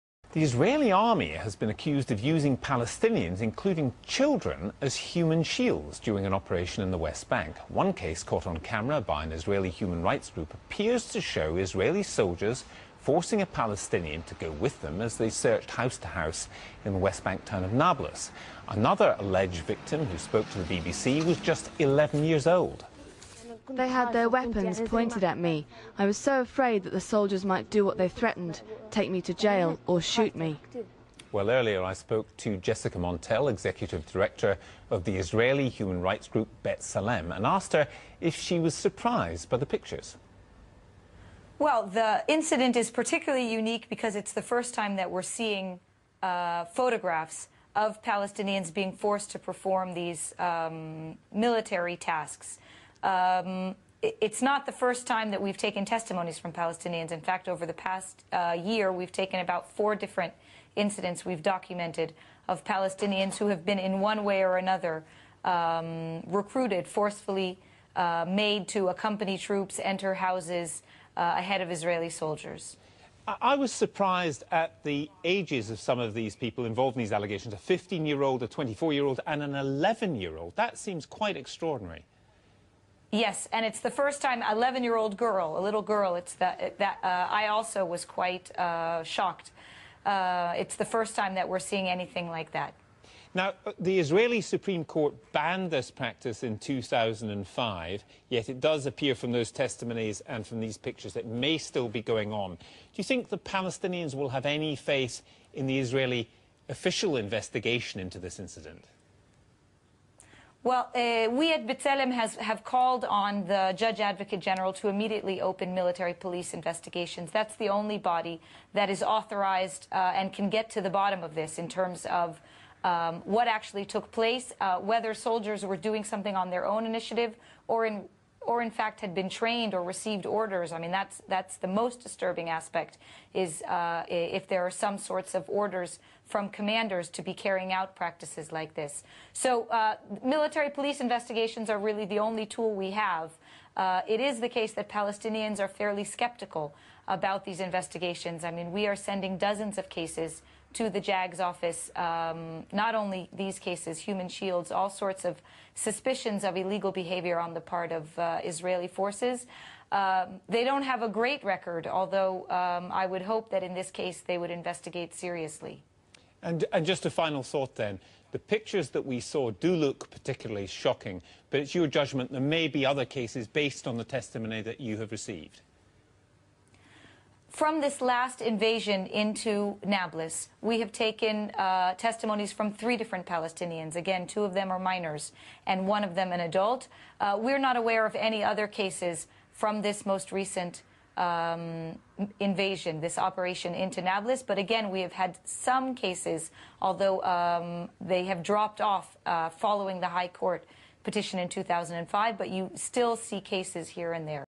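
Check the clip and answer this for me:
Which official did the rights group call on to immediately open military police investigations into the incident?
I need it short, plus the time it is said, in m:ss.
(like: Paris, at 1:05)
Judge Advocate General, at 1:53.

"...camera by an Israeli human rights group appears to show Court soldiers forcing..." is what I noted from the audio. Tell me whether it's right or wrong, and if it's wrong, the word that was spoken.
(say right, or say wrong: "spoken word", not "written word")
wrong: "Israeli", not "Court".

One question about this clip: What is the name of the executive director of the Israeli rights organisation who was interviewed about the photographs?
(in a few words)
Jessica Montell.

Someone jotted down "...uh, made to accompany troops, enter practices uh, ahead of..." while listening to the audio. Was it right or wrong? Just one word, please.
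wrong.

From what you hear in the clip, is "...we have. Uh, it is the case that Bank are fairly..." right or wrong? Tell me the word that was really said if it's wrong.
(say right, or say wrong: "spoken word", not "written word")
wrong: "Palestinians", not "Bank".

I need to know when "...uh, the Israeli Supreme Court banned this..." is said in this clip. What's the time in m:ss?
1:33.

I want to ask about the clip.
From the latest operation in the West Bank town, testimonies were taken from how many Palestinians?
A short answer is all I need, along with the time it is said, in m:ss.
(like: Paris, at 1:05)
3, at 3:02.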